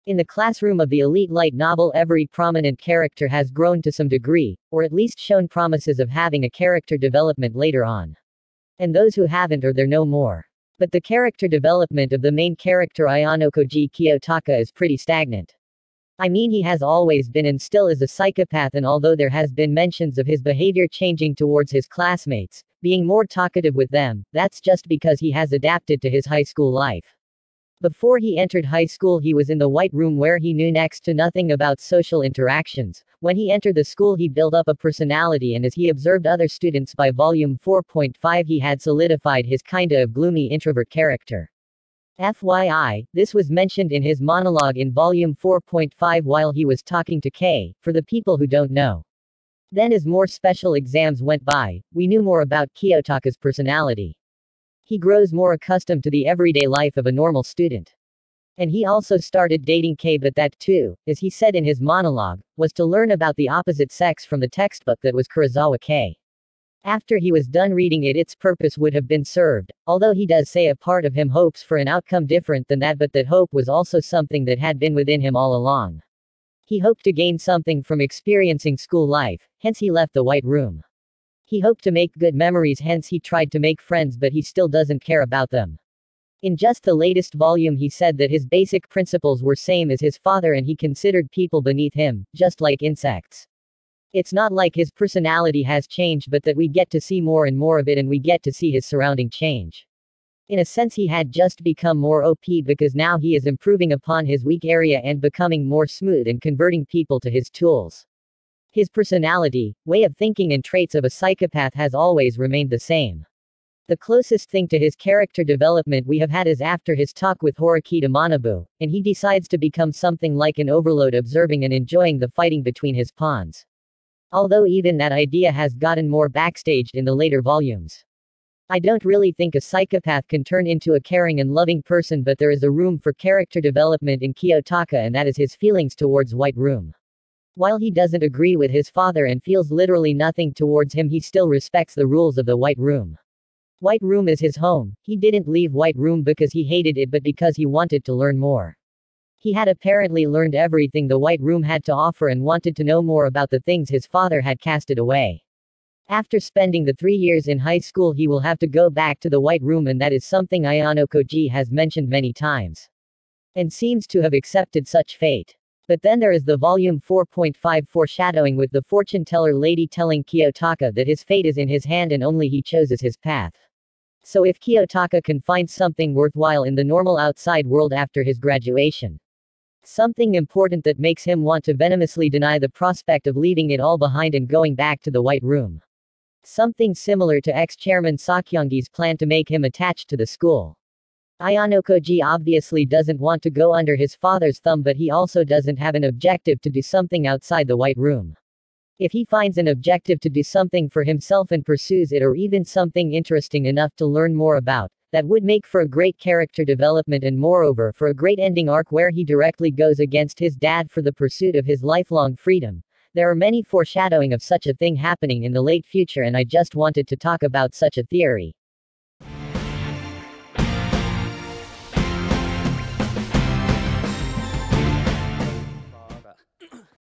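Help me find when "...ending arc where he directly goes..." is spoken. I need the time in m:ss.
3:28.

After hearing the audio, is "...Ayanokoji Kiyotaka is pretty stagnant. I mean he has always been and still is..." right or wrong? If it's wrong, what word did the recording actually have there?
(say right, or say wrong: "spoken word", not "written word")
right.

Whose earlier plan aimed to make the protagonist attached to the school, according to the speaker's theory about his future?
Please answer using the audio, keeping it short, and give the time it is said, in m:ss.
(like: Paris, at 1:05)
ex-chairman Sakayanagi, at 3:07.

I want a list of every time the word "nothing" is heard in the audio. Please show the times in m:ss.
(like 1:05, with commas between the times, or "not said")
0:31, 2:20.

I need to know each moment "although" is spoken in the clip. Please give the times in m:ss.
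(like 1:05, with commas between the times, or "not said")
0:18, 1:09, 2:04.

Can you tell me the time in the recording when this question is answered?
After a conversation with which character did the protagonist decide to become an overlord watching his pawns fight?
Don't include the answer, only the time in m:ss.
1:57.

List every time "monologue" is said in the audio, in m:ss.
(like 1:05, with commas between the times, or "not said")
0:44, 1:01.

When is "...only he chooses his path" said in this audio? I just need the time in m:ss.
2:52.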